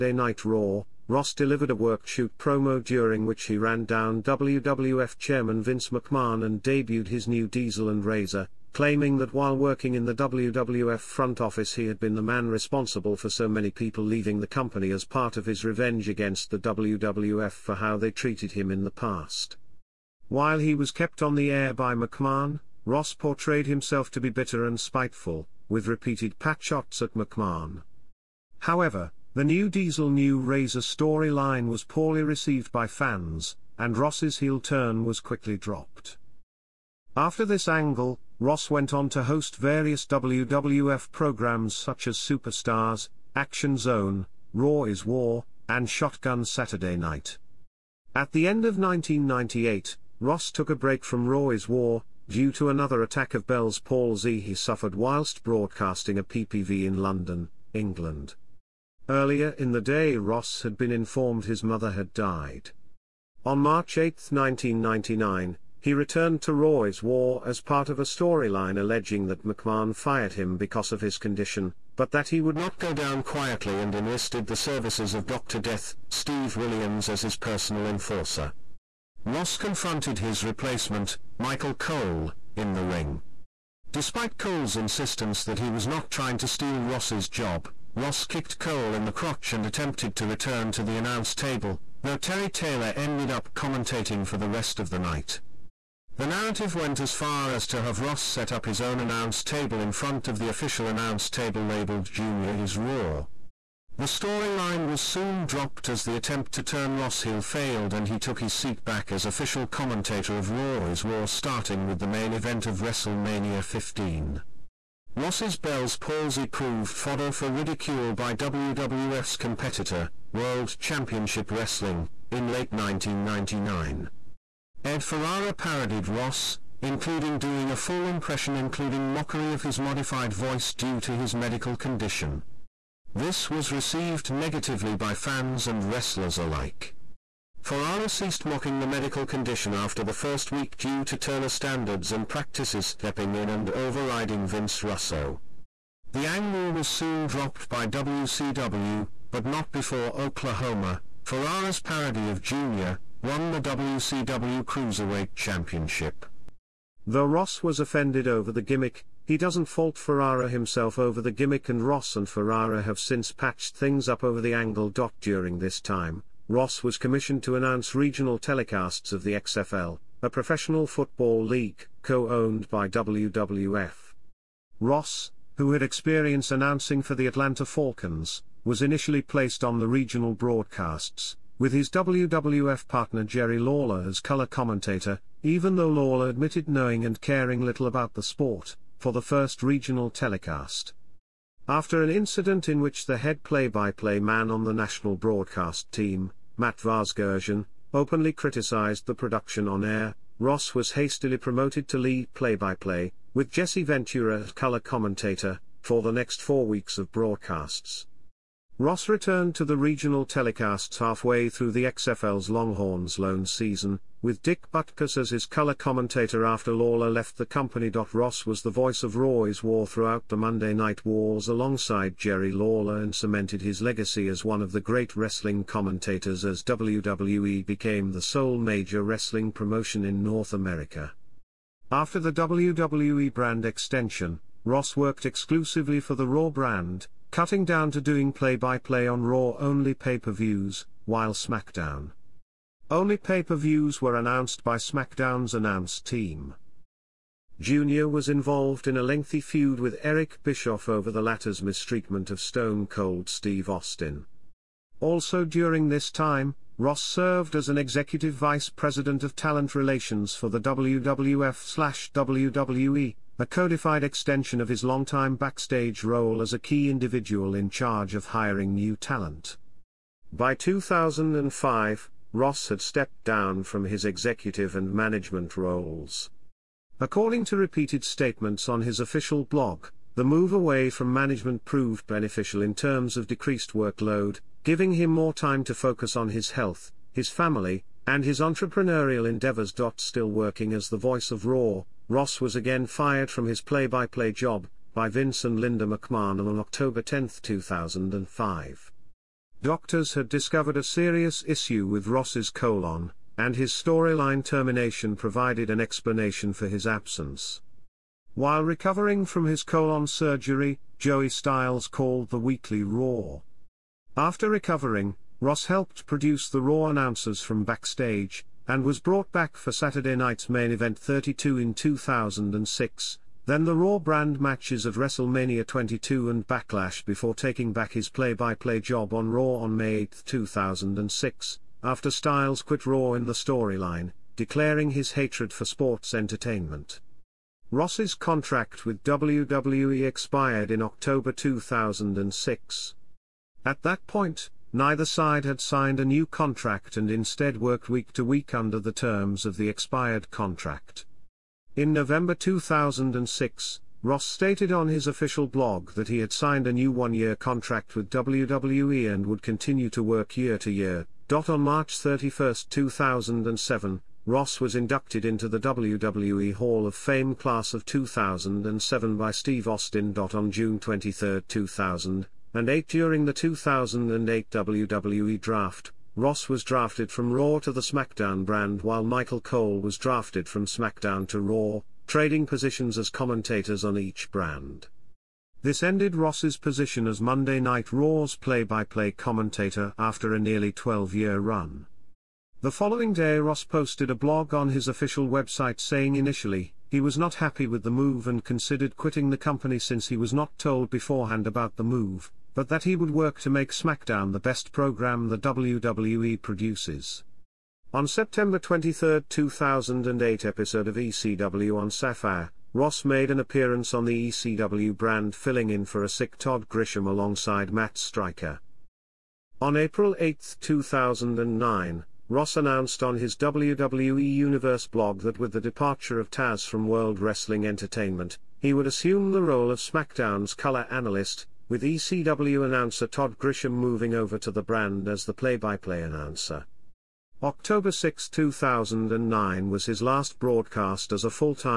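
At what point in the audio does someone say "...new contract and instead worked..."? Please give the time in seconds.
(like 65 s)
346 s.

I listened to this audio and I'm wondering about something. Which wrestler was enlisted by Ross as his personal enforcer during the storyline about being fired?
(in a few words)
Steve Williams.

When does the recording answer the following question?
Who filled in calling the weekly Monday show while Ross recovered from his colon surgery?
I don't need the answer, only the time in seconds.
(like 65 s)
310 s.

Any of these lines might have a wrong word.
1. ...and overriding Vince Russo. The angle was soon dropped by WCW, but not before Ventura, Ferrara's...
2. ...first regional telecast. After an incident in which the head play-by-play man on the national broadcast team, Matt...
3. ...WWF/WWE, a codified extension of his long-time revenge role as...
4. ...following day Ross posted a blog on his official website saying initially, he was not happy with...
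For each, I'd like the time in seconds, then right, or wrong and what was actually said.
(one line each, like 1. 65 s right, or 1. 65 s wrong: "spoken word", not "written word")
1. 143 s wrong: "Oklahoma", not "Ventura"
2. 189 s right
3. 260 s wrong: "backstage", not "revenge"
4. 392 s right.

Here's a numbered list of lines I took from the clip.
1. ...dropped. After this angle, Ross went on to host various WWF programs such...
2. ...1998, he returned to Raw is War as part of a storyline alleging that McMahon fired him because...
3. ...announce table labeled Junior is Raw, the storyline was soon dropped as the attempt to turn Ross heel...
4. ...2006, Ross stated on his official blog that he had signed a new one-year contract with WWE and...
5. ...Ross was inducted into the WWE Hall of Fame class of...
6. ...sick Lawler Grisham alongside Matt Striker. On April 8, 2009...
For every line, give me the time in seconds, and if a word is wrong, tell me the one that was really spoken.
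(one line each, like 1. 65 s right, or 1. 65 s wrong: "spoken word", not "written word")
1. 35 s right
2. 64 s wrong: "1999", not "1998"
3. 100 s right
4. 352 s right
5. 364 s right
6. 416 s wrong: "Todd", not "Lawler".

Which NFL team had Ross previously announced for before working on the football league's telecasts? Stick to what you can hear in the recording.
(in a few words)
Atlanta Falcons.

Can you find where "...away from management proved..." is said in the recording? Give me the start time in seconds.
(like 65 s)
280 s.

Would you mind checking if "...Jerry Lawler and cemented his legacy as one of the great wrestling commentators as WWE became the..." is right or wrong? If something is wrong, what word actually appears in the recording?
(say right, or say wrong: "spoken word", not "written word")
right.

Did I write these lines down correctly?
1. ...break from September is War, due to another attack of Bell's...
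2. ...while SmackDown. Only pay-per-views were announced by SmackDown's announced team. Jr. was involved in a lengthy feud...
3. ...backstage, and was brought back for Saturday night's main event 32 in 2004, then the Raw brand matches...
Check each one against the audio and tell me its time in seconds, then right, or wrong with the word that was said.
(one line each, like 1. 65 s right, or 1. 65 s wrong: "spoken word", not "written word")
1. 50 s wrong: "Raw", not "September"
2. 241 s right
3. 317 s wrong: "2006", not "2004".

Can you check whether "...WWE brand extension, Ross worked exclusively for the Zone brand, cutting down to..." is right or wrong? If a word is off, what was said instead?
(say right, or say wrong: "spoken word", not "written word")
wrong: "Raw", not "Zone".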